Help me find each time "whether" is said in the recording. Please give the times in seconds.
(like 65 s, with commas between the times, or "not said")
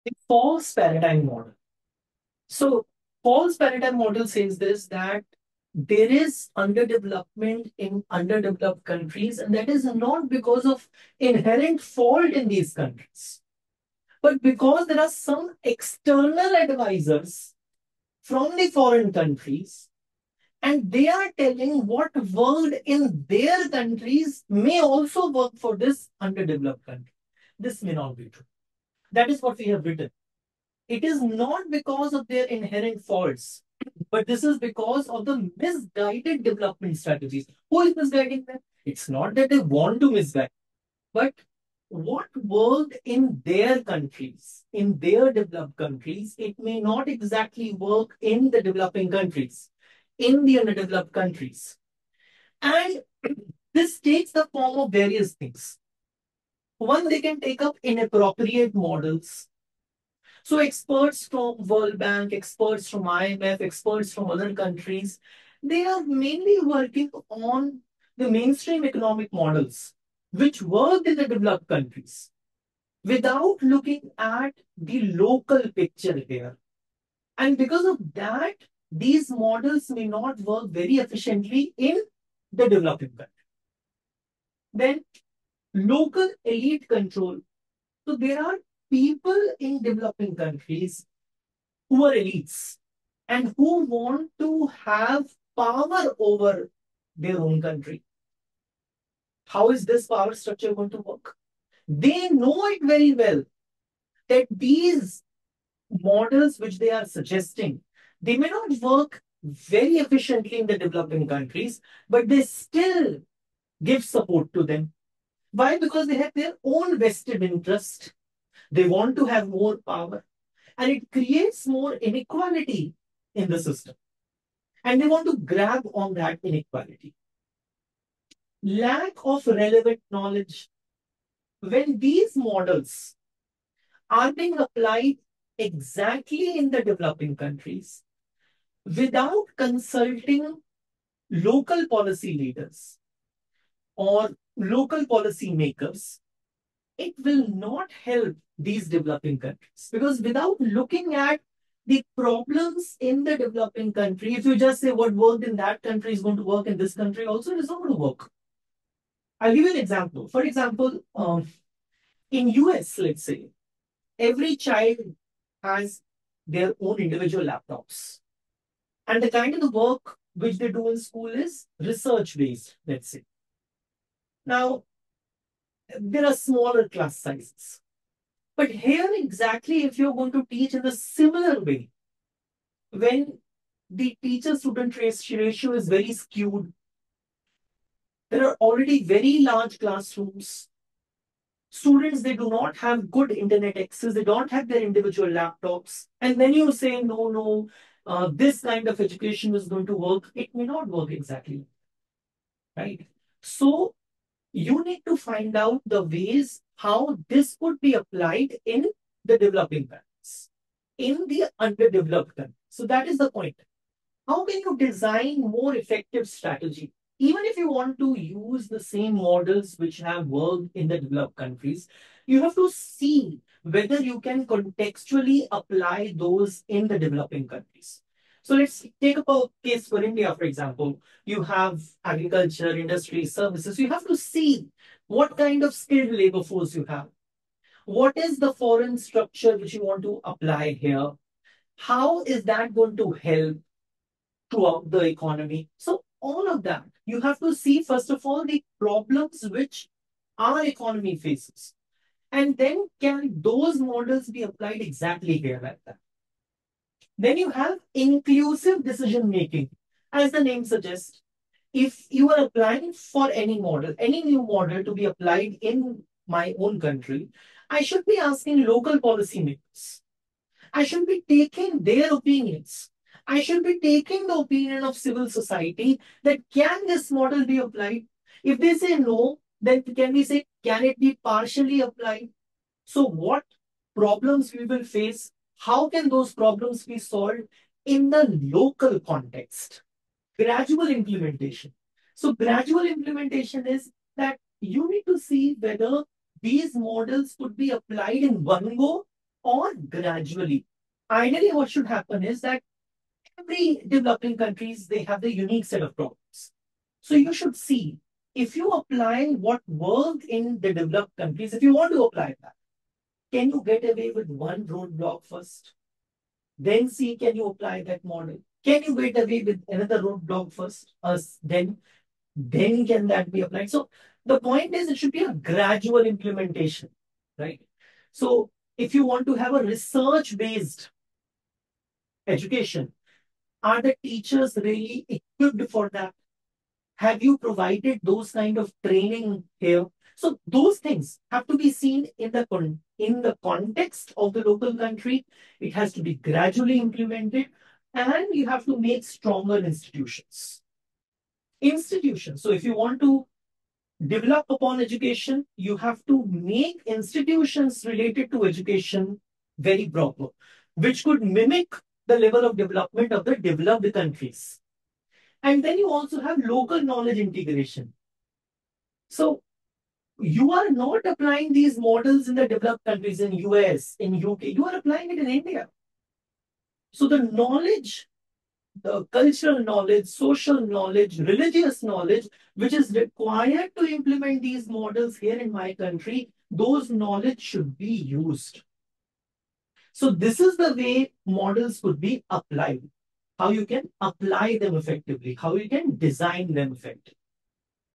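223 s, 295 s.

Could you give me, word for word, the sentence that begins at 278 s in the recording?
If they say no, then can we say, can it be partially applied?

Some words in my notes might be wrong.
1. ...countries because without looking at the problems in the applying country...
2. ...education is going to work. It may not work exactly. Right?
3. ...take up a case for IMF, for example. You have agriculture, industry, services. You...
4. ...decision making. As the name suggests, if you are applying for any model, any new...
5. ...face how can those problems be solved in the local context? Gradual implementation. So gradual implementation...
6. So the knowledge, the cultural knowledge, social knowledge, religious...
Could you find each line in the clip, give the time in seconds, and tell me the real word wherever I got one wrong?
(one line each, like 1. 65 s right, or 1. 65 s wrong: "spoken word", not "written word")
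1. 149 s wrong: "developing", not "applying"
2. 198 s right
3. 228 s wrong: "India", not "IMF"
4. 258 s right
5. 284 s right
6. 376 s right.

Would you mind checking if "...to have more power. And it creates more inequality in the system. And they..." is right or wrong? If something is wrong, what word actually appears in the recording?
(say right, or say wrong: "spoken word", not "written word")
right.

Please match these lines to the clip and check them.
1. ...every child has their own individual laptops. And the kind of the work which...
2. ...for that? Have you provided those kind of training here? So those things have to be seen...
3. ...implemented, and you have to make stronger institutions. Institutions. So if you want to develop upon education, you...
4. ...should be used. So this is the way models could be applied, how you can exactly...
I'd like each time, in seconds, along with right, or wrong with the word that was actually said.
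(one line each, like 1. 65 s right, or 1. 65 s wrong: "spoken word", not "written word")
1. 164 s right
2. 335 s right
3. 346 s right
4. 387 s wrong: "apply", not "exactly".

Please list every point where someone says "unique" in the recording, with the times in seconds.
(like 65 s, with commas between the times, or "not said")
305 s.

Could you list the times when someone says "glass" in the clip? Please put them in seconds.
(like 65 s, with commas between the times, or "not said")
not said.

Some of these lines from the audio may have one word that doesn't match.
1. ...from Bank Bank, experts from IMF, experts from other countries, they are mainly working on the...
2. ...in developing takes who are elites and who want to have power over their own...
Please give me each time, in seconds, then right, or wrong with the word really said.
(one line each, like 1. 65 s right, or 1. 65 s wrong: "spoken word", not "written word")
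1. 61 s wrong: "World", not "Bank"
2. 89 s wrong: "countries", not "takes".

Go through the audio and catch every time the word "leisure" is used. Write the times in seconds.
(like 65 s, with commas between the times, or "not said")
not said.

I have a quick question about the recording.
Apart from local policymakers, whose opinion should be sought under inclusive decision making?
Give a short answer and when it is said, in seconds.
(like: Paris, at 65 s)
Civil society, at 274 s.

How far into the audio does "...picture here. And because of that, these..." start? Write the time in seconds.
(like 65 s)
75 s.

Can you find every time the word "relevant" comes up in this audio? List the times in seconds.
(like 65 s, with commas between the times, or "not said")
129 s.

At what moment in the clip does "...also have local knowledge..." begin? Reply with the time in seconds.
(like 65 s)
365 s.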